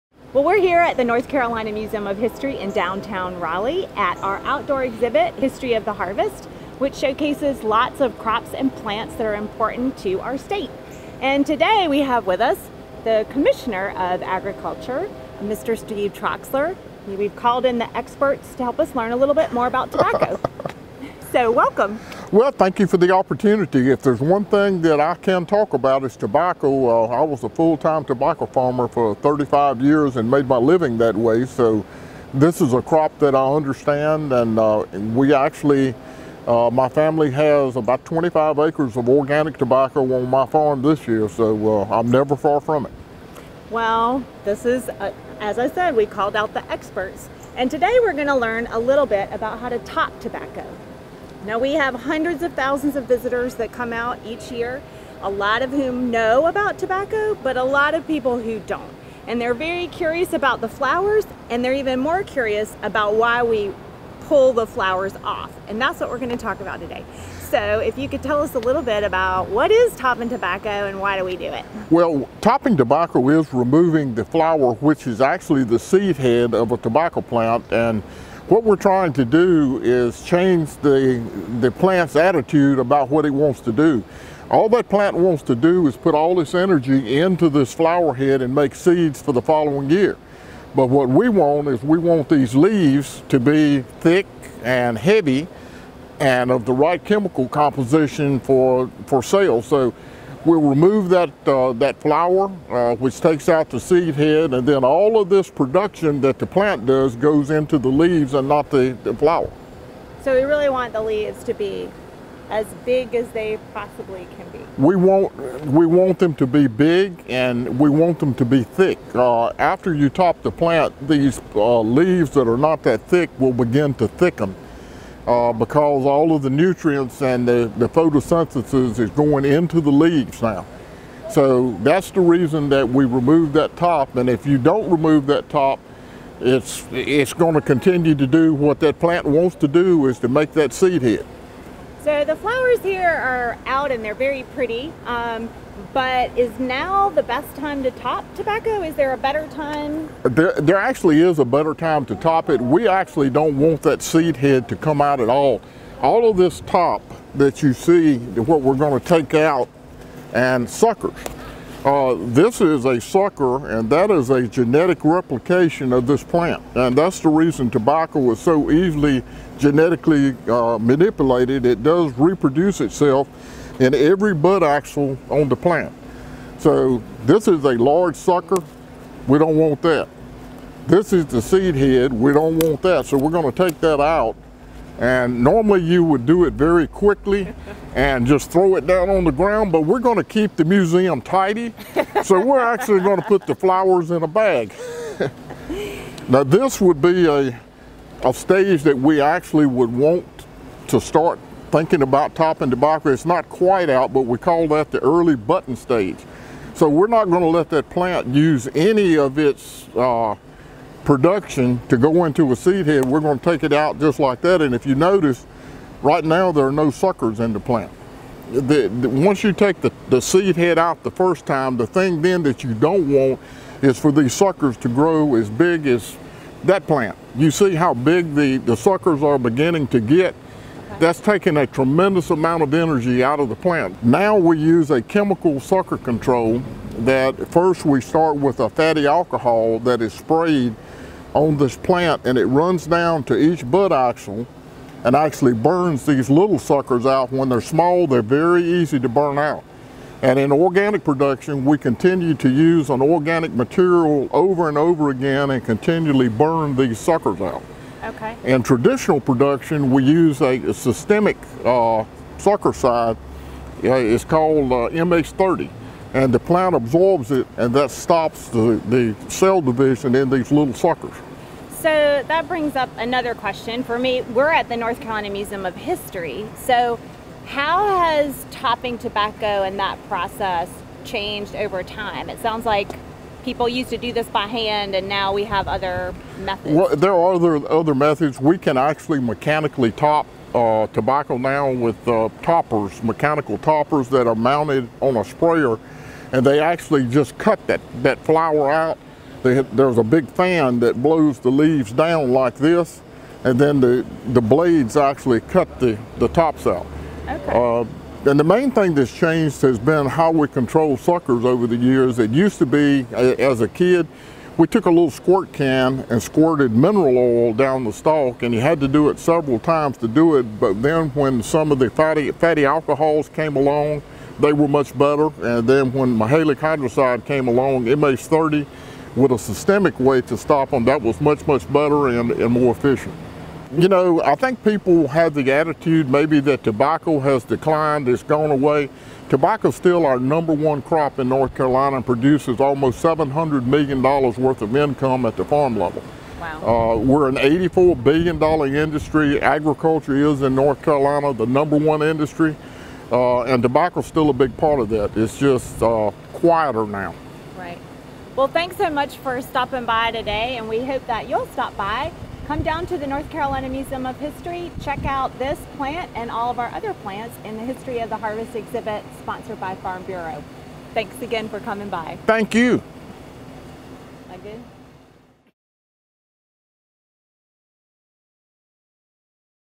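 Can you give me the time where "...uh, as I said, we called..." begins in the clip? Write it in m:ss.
0:44.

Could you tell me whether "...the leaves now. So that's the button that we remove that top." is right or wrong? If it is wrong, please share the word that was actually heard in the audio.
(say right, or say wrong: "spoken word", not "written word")
wrong: "reason", not "button".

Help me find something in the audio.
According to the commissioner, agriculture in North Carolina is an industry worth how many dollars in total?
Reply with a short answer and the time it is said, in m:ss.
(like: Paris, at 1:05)
$84 billion, at 5:47.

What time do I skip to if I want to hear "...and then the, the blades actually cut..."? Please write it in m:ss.
5:03.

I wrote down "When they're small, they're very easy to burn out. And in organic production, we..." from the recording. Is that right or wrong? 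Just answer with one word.
right.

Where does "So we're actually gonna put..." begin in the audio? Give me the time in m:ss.
3:12.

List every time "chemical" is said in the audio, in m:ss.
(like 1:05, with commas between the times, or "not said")
1:37, 3:55.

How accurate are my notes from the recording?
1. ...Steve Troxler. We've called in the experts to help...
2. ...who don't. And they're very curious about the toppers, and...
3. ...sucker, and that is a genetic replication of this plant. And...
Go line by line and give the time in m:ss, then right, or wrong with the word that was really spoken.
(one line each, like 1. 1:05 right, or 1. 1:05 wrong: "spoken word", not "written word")
1. 0:15 right
2. 0:58 wrong: "flowers", not "toppers"
3. 2:43 right.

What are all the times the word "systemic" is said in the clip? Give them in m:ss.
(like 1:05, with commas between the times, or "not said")
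4:20, 5:29.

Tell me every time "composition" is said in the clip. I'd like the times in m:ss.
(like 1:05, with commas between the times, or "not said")
1:37.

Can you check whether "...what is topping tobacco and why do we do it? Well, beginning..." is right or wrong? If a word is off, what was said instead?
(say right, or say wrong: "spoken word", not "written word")
wrong: "topping", not "beginning".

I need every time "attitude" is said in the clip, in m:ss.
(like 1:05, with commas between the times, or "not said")
1:22, 5:35.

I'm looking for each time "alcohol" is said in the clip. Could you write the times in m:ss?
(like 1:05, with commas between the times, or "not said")
3:59, 5:22.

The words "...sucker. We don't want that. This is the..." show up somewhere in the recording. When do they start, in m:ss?
2:58.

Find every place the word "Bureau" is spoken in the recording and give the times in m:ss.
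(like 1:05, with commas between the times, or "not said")
6:10.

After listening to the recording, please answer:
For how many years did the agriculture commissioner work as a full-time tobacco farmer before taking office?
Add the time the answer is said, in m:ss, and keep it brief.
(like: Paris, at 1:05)
35, at 0:29.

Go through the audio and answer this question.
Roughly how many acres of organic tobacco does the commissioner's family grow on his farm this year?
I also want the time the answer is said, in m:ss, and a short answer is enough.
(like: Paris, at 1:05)
25, at 0:38.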